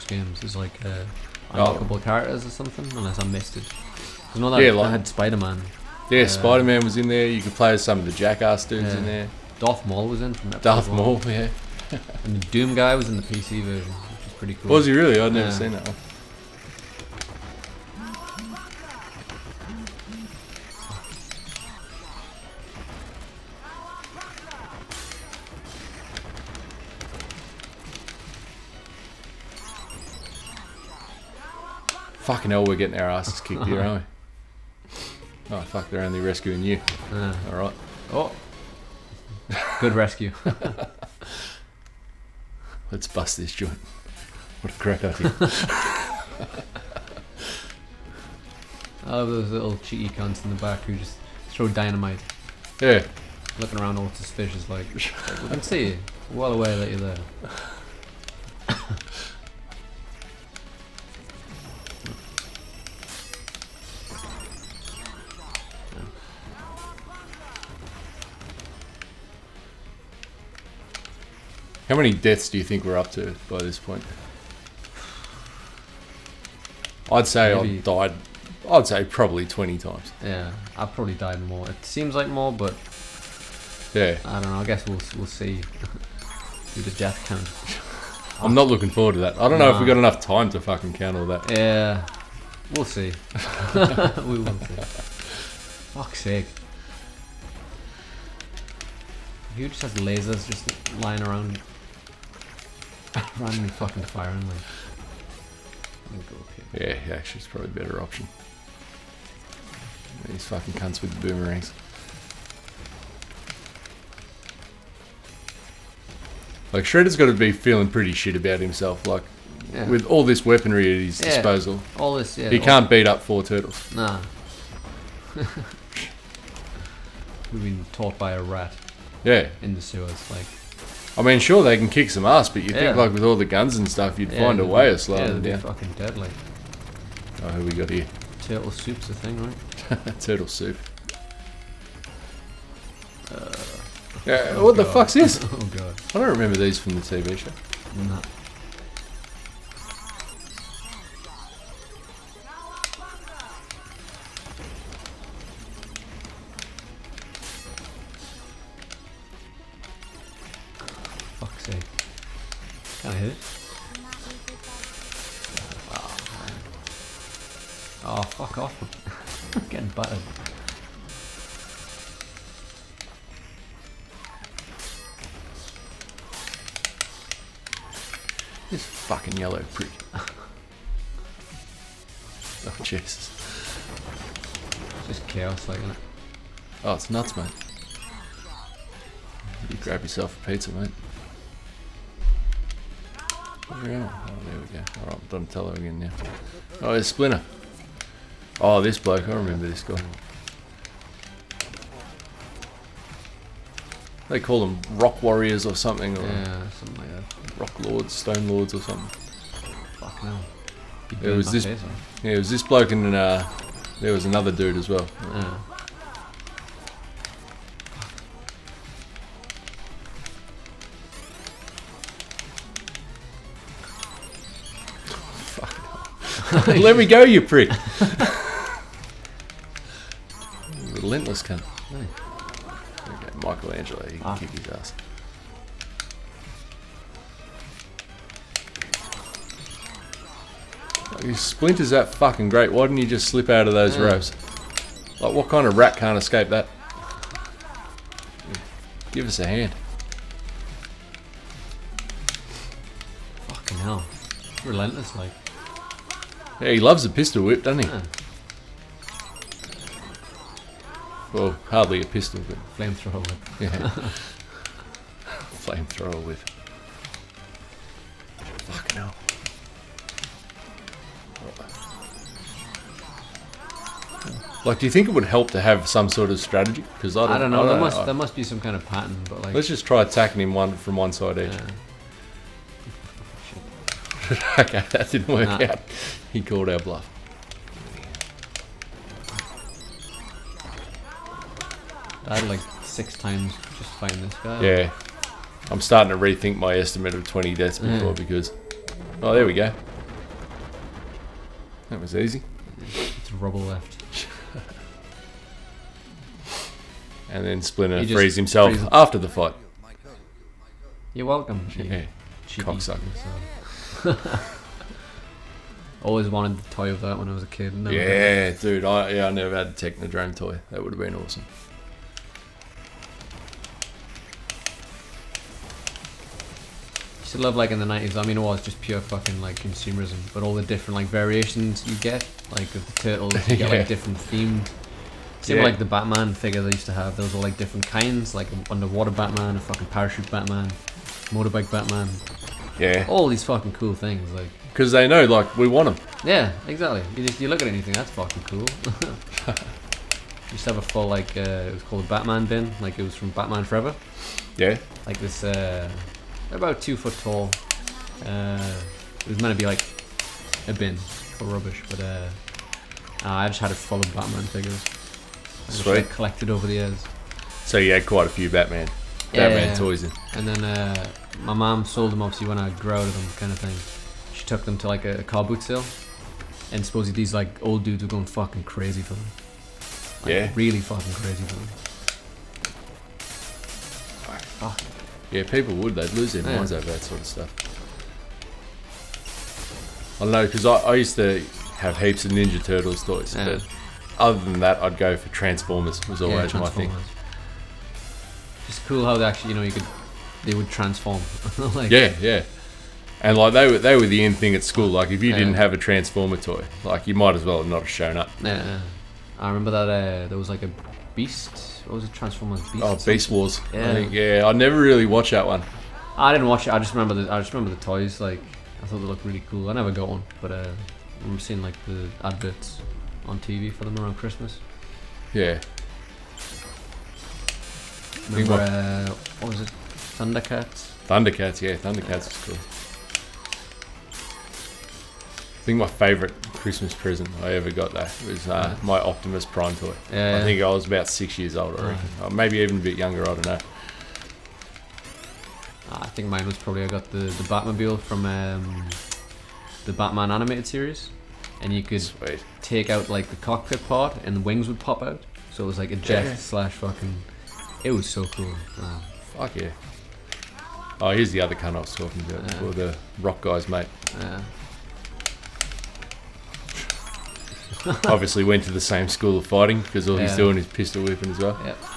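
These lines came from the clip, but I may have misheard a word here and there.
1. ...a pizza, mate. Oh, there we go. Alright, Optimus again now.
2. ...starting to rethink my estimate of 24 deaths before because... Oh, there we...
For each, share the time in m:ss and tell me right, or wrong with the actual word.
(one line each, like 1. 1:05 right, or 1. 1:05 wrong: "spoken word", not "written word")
1. 3:10 wrong: "Donatello", not "Optimus"
2. 4:55 wrong: "20", not "24".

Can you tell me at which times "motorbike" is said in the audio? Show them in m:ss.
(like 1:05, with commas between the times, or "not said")
5:41.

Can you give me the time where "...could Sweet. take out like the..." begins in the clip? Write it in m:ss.
7:31.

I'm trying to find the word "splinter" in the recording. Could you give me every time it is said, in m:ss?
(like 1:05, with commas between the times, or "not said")
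3:17, 4:01, 5:07.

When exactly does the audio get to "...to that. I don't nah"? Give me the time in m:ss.
1:29.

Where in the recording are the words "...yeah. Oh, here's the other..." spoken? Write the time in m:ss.
7:39.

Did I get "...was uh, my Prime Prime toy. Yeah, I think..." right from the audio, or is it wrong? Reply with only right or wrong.
wrong.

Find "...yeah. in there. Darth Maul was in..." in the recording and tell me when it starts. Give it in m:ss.
0:08.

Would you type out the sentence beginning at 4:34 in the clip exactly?
Like, do you think it would help to have some sort of strategy?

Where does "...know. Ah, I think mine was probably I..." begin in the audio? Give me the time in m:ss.
7:23.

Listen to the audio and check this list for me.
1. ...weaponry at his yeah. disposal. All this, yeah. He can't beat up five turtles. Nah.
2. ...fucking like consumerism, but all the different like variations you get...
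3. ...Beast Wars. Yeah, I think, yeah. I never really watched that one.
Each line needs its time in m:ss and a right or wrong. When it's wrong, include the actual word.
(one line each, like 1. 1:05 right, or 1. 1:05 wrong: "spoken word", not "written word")
1. 2:00 wrong: "four", not "five"
2. 5:29 right
3. 6:53 right.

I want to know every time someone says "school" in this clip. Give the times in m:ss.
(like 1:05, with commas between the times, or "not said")
6:44, 7:49.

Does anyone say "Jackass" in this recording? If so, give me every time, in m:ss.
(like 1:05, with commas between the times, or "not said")
0:08.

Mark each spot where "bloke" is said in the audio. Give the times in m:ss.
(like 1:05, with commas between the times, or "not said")
3:18, 3:32.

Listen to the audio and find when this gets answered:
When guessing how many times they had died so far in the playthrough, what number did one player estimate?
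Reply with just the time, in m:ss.
1:19.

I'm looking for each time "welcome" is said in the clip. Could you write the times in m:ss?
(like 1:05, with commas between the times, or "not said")
5:11.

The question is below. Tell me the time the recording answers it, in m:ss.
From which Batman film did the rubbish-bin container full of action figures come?
5:53.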